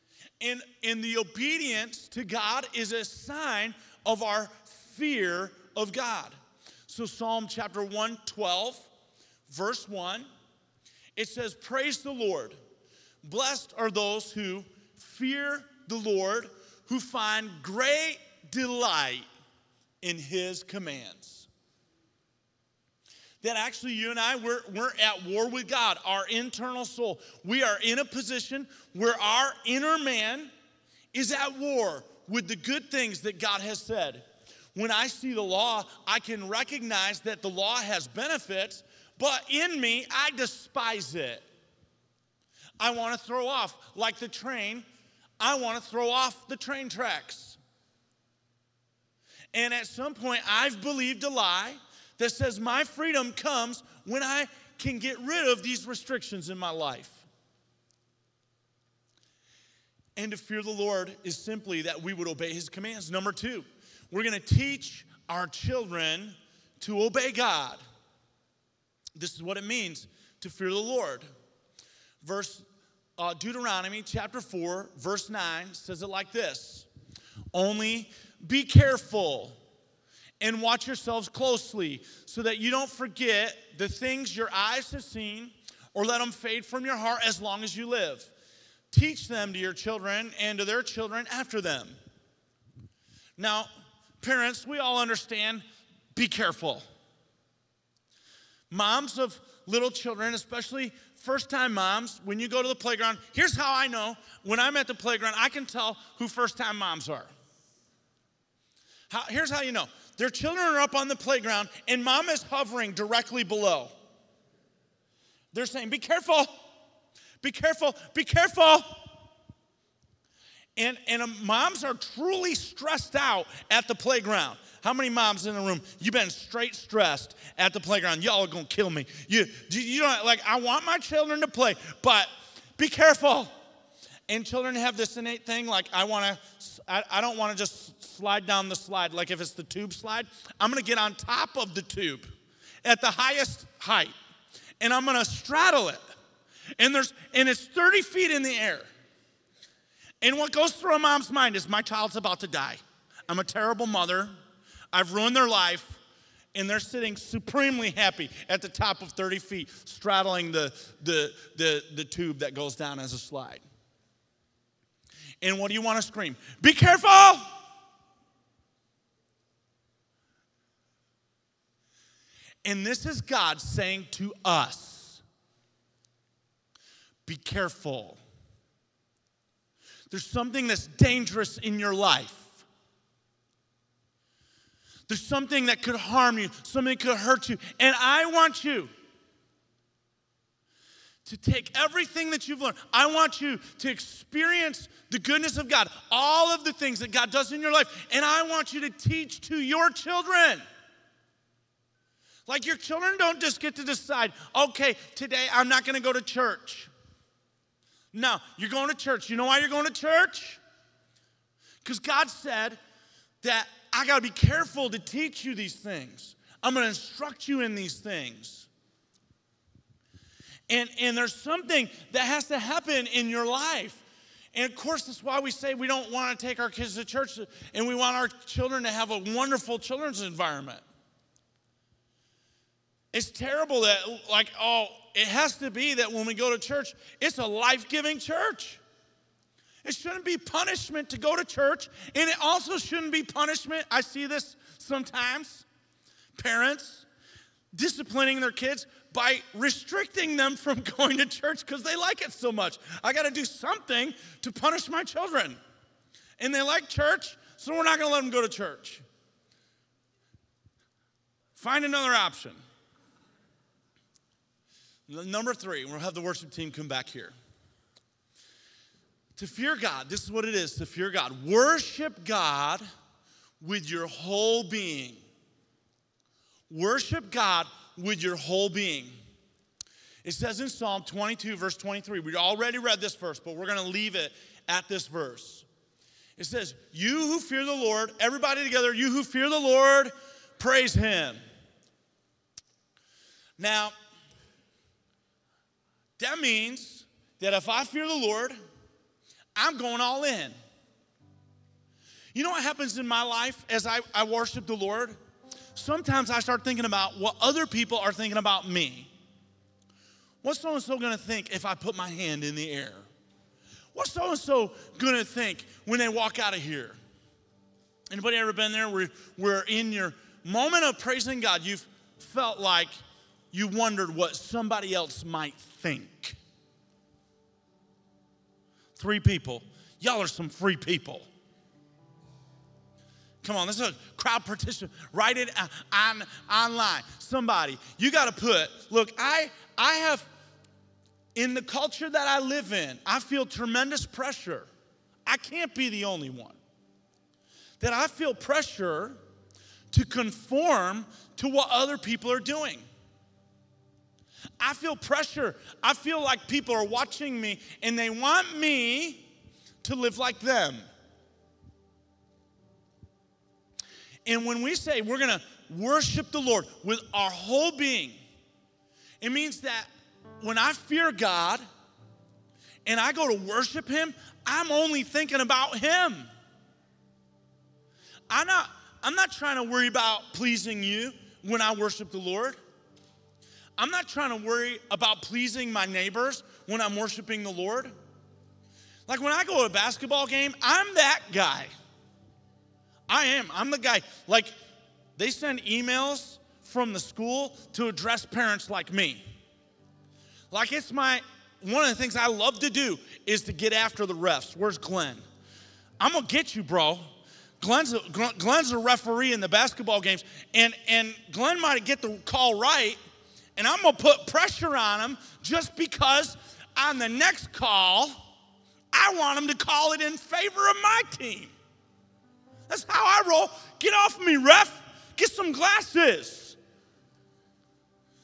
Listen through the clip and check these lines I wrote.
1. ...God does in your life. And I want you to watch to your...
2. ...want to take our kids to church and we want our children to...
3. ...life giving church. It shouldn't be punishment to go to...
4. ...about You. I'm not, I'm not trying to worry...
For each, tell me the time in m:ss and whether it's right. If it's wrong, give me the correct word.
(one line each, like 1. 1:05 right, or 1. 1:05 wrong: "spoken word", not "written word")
1. 3:17 wrong: "teach", not "watch"
2. 3:46 right
3. 3:57 right
4. 6:15 wrong: "Him", not "You".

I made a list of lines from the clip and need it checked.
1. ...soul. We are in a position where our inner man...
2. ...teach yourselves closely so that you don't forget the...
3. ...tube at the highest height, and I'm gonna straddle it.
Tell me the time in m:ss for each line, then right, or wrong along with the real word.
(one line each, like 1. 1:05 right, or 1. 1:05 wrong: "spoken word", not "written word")
1. 0:26 right
2. 1:20 wrong: "watch", not "teach"
3. 2:21 right.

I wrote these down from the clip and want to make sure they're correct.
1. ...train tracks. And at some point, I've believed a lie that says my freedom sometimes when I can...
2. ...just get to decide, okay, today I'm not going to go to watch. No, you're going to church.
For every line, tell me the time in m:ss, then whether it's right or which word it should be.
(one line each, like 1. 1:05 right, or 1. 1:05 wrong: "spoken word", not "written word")
1. 0:46 wrong: "comes", not "sometimes"
2. 3:23 wrong: "church", not "watch".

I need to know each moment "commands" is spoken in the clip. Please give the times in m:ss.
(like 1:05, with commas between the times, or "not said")
0:20, 1:02.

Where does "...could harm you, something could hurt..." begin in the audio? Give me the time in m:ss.
3:05.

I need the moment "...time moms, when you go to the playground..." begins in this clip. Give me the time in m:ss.
1:41.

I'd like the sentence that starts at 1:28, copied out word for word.
Teach them to your children and to their children after them.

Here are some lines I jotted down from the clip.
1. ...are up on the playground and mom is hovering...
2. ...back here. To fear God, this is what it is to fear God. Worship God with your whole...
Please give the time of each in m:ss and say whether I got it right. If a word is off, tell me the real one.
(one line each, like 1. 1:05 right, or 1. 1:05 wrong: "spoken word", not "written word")
1. 1:50 right
2. 4:26 right.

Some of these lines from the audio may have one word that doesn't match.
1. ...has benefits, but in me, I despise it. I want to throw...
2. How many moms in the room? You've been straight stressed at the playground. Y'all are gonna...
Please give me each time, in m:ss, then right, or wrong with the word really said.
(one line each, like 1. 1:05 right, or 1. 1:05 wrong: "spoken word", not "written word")
1. 0:37 right
2. 2:04 right.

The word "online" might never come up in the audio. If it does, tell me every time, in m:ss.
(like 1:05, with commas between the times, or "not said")
5:36.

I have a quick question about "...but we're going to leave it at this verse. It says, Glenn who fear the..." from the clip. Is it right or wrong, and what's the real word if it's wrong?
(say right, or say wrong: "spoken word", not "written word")
wrong: "You", not "Glenn".